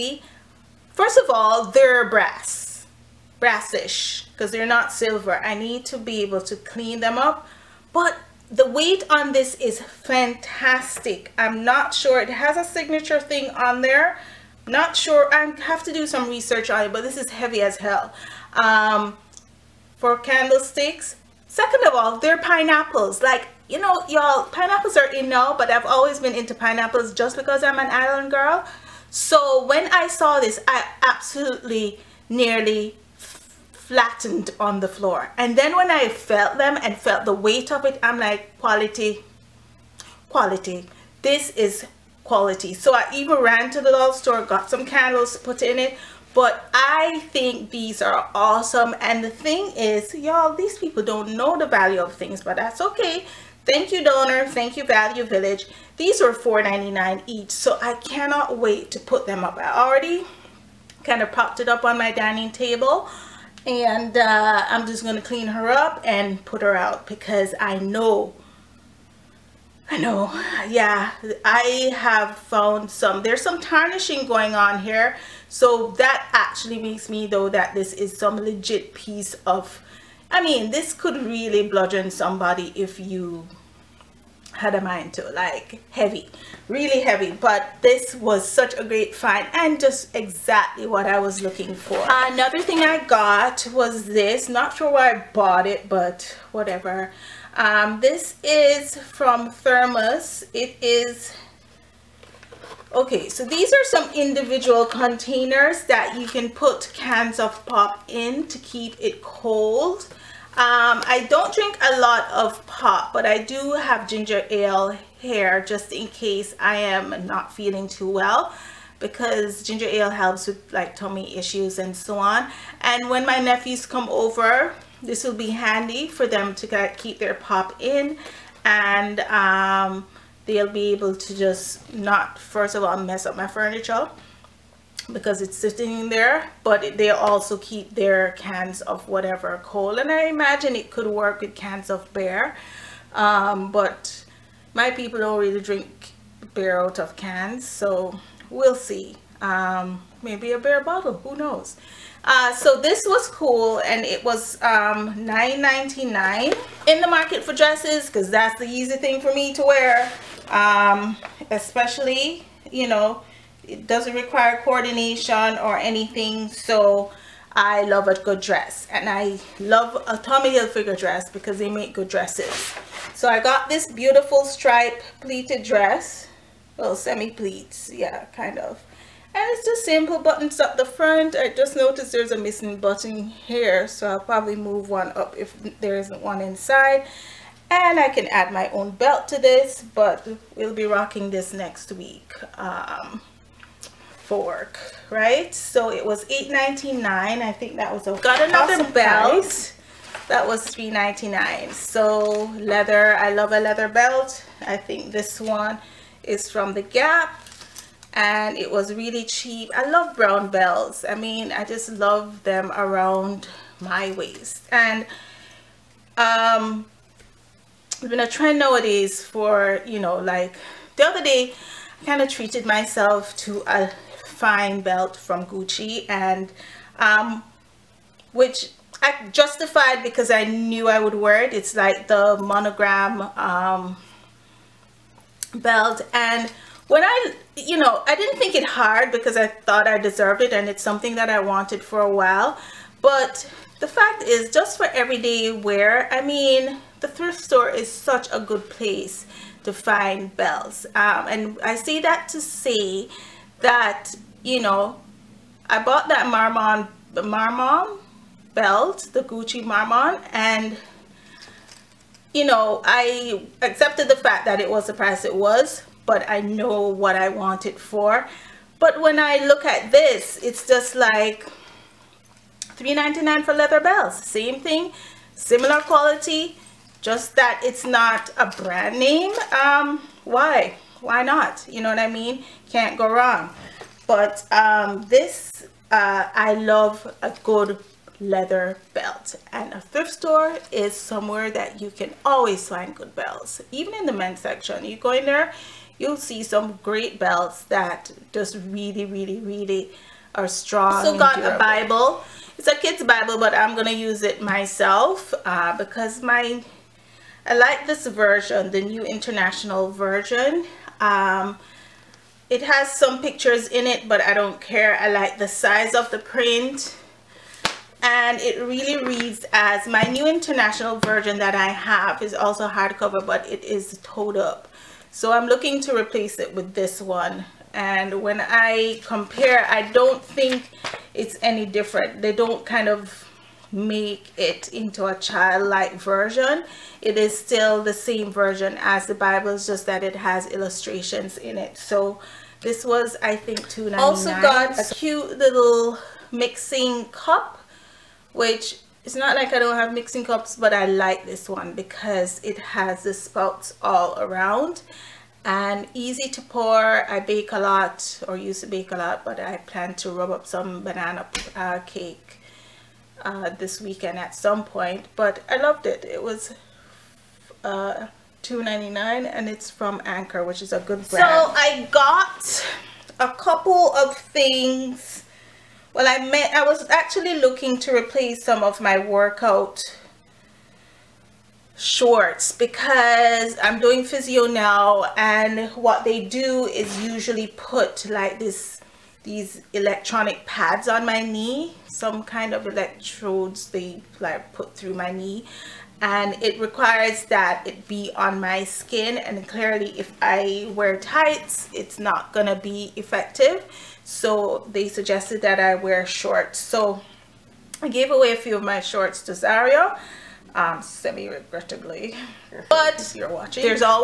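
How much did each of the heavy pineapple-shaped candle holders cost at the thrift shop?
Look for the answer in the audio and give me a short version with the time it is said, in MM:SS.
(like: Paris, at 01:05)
$4.99, at 00:56.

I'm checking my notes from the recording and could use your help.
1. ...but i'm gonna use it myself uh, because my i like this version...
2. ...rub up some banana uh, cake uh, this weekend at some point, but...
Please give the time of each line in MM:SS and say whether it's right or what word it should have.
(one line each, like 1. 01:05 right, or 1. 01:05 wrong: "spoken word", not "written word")
1. 05:03 right
2. 06:00 right.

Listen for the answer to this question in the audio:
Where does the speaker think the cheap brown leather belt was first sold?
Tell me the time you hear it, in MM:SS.
03:26.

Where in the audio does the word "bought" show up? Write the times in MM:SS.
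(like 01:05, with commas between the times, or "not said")
01:35, 04:15.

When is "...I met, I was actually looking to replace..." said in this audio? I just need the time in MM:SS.
06:16.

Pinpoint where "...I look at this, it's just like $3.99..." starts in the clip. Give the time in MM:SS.
04:29.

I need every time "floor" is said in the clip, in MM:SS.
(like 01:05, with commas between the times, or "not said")
00:34.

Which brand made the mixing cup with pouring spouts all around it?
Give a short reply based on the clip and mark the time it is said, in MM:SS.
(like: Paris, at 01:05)
Anchor, at 06:10.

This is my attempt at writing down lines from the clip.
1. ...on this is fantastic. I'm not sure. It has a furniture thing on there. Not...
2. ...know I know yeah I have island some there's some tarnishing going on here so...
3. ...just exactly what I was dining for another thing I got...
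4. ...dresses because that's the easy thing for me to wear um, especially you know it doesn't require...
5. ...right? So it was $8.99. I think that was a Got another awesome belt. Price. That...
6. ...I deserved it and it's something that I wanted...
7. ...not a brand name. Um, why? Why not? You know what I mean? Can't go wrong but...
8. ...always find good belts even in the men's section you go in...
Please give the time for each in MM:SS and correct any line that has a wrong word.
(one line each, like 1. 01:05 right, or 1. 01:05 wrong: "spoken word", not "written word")
1. 00:09 wrong: "signature", not "furniture"
2. 01:07 wrong: "found", not "island"
3. 01:29 wrong: "looking", not "dining"
4. 02:37 right
5. 03:15 right
6. 03:59 right
7. 04:37 right
8. 04:52 right.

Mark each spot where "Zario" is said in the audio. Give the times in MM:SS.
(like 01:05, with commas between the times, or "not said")
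06:49.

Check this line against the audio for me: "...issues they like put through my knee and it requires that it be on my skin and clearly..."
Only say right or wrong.
wrong.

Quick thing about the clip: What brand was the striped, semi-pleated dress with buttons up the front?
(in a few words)
Tommy Hilfiger.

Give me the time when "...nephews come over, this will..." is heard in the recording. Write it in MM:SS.
02:03.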